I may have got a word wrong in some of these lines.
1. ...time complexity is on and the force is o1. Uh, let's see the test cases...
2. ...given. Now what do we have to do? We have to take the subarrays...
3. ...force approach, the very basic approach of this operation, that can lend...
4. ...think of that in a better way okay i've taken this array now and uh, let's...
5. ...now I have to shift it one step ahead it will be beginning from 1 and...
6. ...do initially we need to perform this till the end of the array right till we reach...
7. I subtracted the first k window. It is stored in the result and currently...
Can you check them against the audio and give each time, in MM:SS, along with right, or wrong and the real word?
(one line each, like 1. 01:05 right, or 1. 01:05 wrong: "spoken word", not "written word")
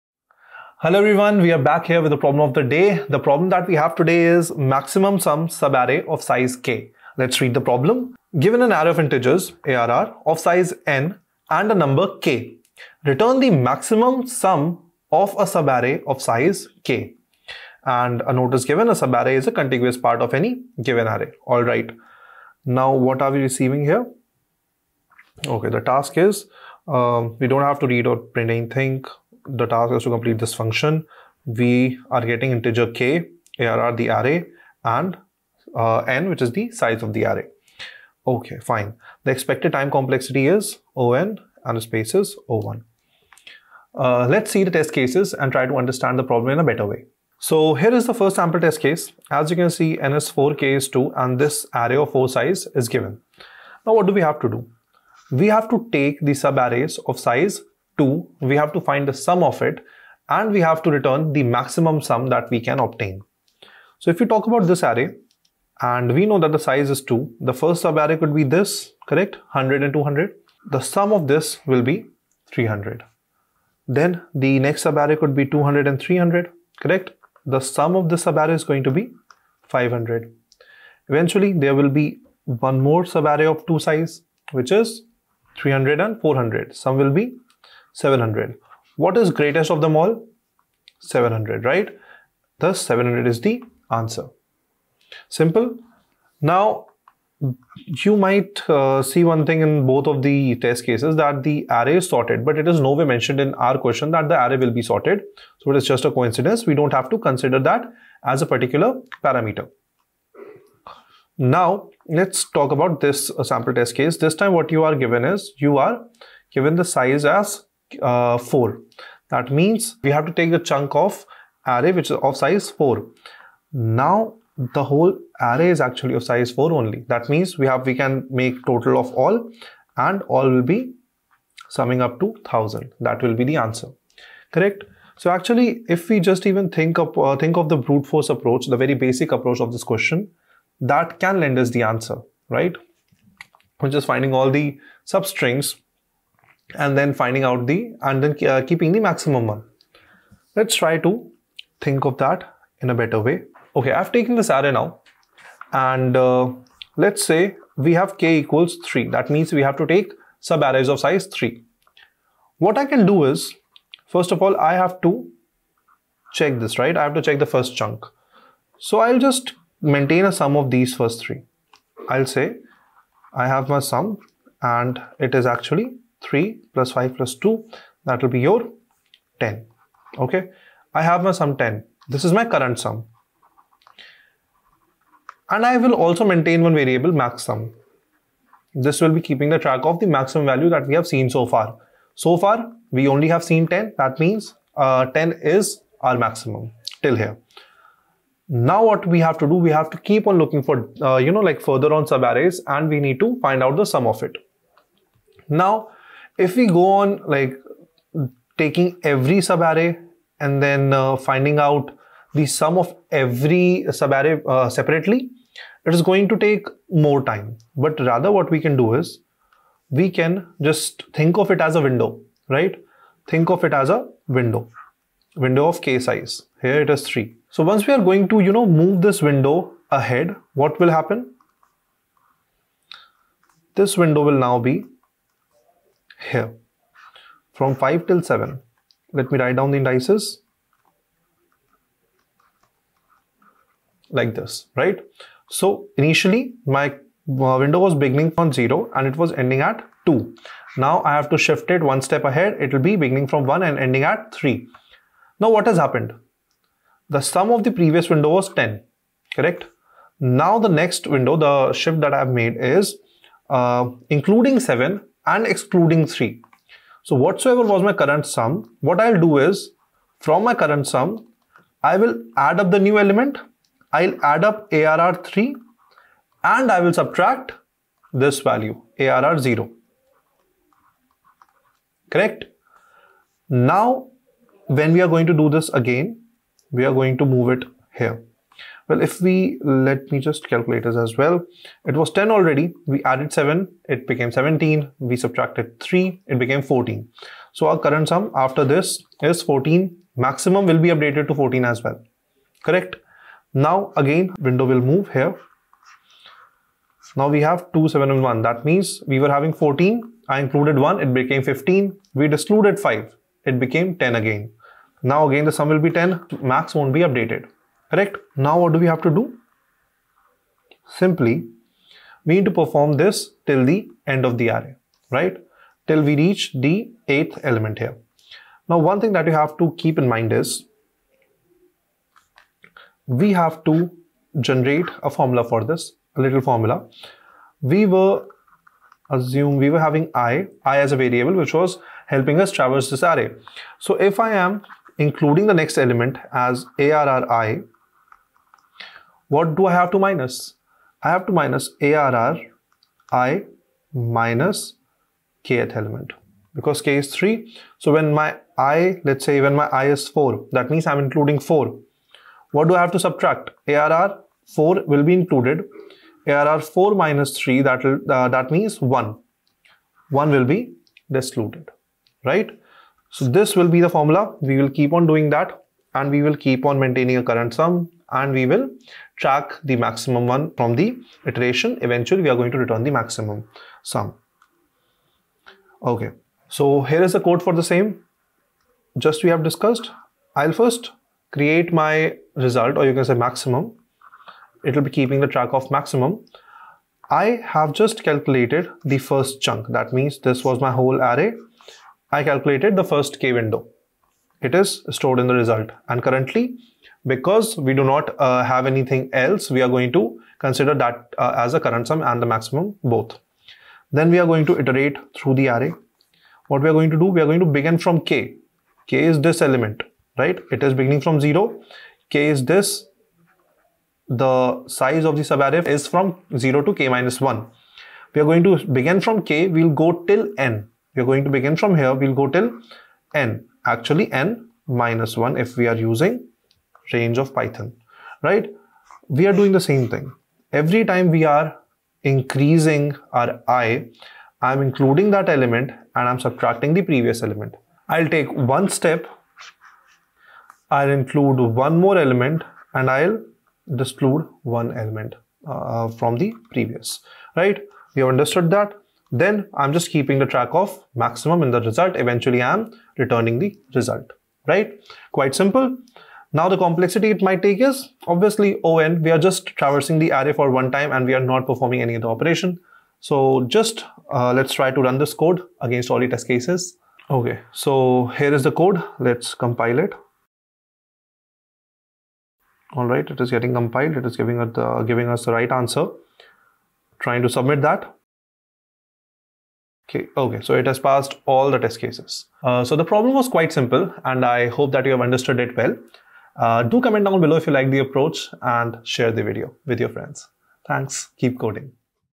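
1. 00:39 wrong: "space", not "force"
2. 00:52 right
3. 02:18 wrong: "question", not "operation"
4. 02:31 right
5. 04:10 right
6. 05:19 wrong: "simply", not "initially"
7. 06:42 wrong: "calculated", not "subtracted".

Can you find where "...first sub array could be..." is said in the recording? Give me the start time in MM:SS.
01:07.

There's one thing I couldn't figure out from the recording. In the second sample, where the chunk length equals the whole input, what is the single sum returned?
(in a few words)
1000.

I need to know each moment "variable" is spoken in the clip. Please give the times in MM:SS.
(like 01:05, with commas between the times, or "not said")
03:06, 05:41.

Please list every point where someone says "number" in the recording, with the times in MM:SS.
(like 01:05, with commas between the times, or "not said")
00:11.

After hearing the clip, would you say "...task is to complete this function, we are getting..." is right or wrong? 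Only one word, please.
right.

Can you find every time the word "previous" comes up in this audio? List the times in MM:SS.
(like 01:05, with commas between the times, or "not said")
04:17, 07:26, 07:36.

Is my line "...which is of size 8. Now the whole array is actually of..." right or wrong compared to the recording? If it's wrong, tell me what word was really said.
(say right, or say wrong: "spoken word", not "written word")
wrong: "4", not "8".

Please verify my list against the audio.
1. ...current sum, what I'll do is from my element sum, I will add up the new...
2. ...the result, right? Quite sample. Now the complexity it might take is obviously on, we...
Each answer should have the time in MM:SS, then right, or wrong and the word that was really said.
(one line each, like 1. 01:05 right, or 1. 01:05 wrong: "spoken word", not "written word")
1. 04:27 wrong: "current", not "element"
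2. 07:43 wrong: "simple", not "sample".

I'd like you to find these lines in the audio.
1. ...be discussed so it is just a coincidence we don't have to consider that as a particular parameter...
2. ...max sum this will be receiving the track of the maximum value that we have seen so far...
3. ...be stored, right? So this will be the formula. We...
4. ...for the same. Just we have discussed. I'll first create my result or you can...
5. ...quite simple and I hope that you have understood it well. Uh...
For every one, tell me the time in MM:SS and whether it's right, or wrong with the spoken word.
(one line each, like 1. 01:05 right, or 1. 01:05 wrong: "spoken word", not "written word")
1. 01:44 wrong: "sorted", not "discussed"
2. 03:07 wrong: "keeping", not "receiving"
3. 06:10 wrong: "excluded", not "stored"
4. 06:27 right
5. 08:13 right.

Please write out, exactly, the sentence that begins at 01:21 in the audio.
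Eventually, there will be one more sub array of two size, which is 300 and 400.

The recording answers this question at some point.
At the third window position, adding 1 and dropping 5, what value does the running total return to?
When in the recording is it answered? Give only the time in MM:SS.
05:13.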